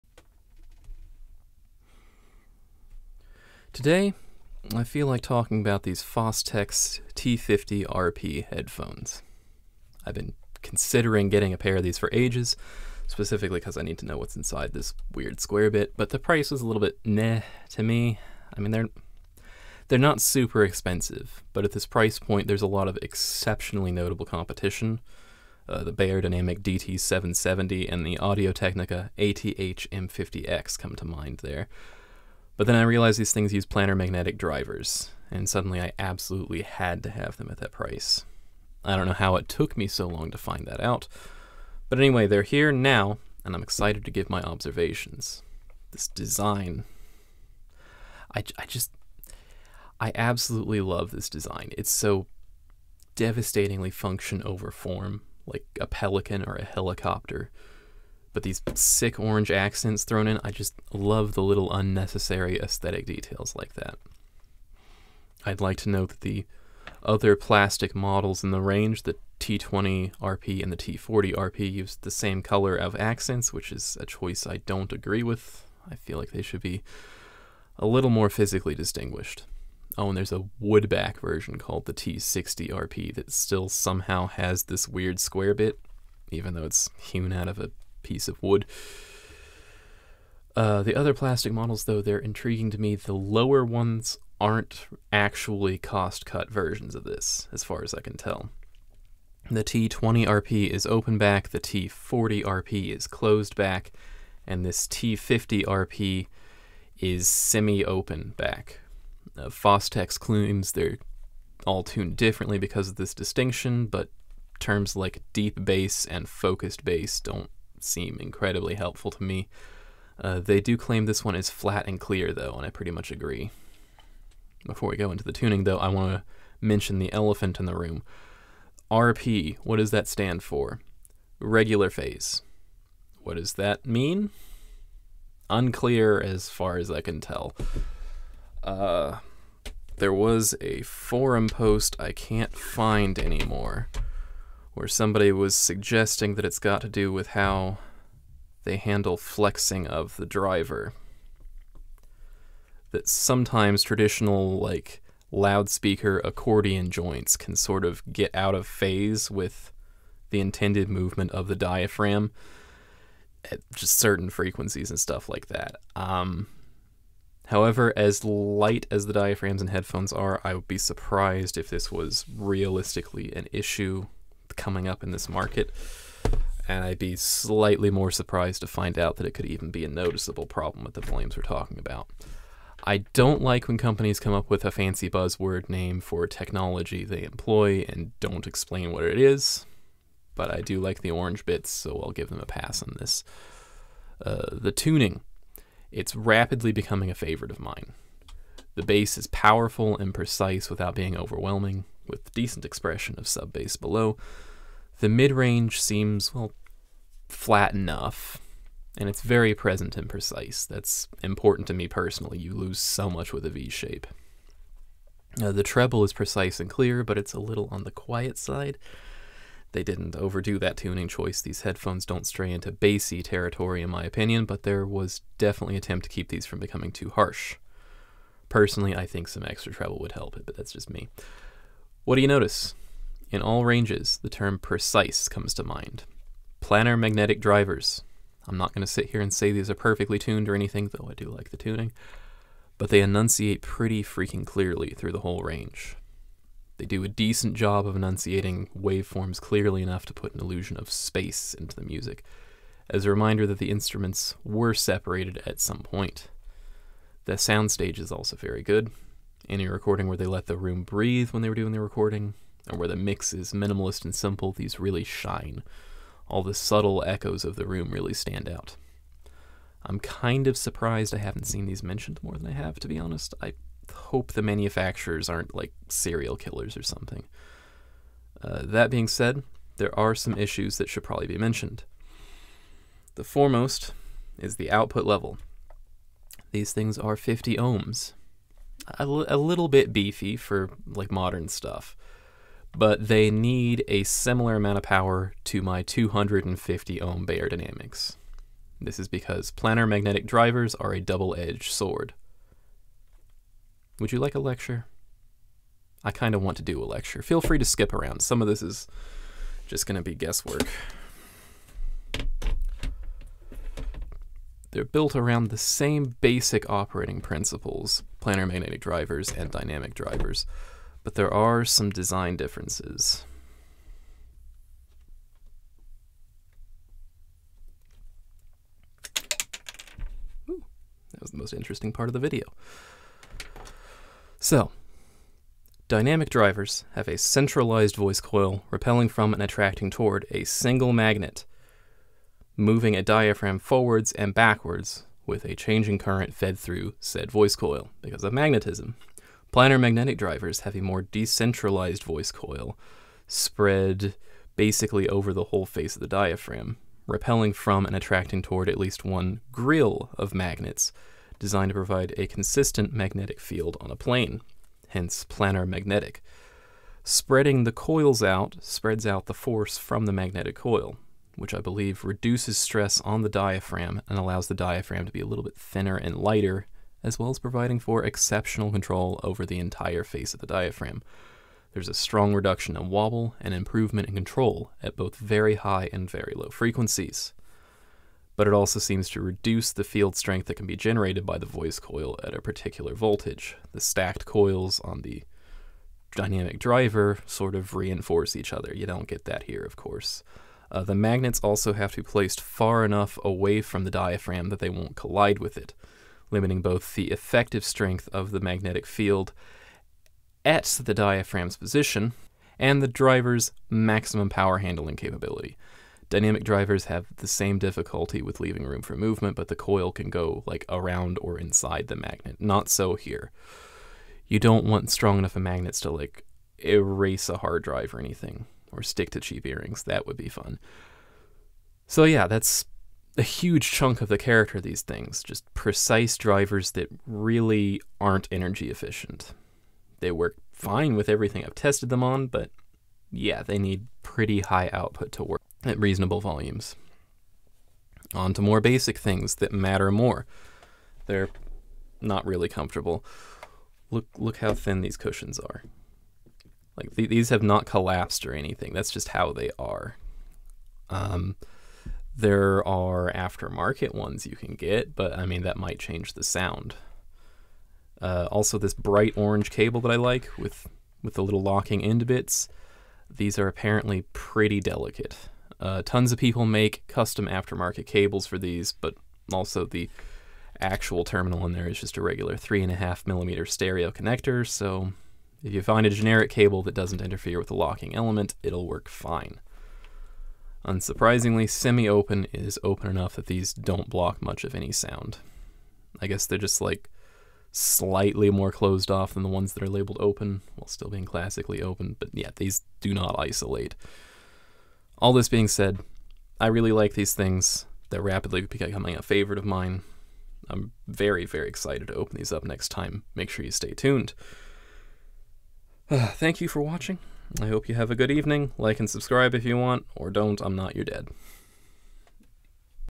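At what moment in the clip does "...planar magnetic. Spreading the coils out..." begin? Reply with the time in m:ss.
6:05.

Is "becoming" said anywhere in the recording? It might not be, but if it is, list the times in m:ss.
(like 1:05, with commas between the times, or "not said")
3:16, 3:46, 8:28.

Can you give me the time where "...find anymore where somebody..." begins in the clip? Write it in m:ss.
2:22.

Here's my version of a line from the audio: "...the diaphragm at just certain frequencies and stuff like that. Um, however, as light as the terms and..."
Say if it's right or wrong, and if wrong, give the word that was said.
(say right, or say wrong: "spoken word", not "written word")
wrong: "diaphragms", not "terms".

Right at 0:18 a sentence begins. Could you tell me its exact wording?
I mean, they're they're not super expensive, but at this price point, there's a lot of exceptionally notable competition.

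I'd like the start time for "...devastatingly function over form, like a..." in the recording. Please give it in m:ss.
0:53.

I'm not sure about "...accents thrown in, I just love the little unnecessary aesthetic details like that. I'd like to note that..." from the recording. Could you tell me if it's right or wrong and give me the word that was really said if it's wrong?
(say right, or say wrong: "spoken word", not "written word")
right.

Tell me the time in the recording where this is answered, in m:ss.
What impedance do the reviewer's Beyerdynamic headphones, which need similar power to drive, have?
4:55.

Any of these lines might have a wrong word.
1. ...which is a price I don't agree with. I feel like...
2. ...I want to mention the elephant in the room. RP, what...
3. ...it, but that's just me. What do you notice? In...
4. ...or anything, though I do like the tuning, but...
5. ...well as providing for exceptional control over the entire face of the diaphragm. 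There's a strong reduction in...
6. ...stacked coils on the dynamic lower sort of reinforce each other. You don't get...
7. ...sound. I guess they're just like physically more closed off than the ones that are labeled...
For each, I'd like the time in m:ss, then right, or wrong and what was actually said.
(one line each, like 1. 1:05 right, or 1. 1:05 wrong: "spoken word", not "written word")
1. 1:13 wrong: "choice", not "price"
2. 2:05 right
3. 3:50 right
4. 4:00 right
5. 6:17 right
6. 6:33 wrong: "driver", not "lower"
7. 8:14 wrong: "slightly", not "physically".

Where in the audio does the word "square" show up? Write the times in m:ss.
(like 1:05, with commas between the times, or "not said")
0:15, 1:25.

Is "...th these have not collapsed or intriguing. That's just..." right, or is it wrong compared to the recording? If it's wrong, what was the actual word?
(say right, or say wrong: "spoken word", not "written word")
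wrong: "anything", not "intriguing".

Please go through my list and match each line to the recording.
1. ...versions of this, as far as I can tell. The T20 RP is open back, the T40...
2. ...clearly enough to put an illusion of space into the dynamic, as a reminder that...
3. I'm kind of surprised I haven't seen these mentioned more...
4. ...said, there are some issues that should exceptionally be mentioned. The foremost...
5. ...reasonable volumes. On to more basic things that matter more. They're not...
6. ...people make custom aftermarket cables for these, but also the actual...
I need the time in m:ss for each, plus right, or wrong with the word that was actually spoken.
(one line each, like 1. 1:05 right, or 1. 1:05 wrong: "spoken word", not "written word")
1. 1:36 right
2. 4:09 wrong: "music", not "dynamic"
3. 4:29 right
4. 4:39 wrong: "probably", not "exceptionally"
5. 7:25 right
6. 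7:56 right.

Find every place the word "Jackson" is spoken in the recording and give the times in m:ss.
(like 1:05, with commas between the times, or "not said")
not said.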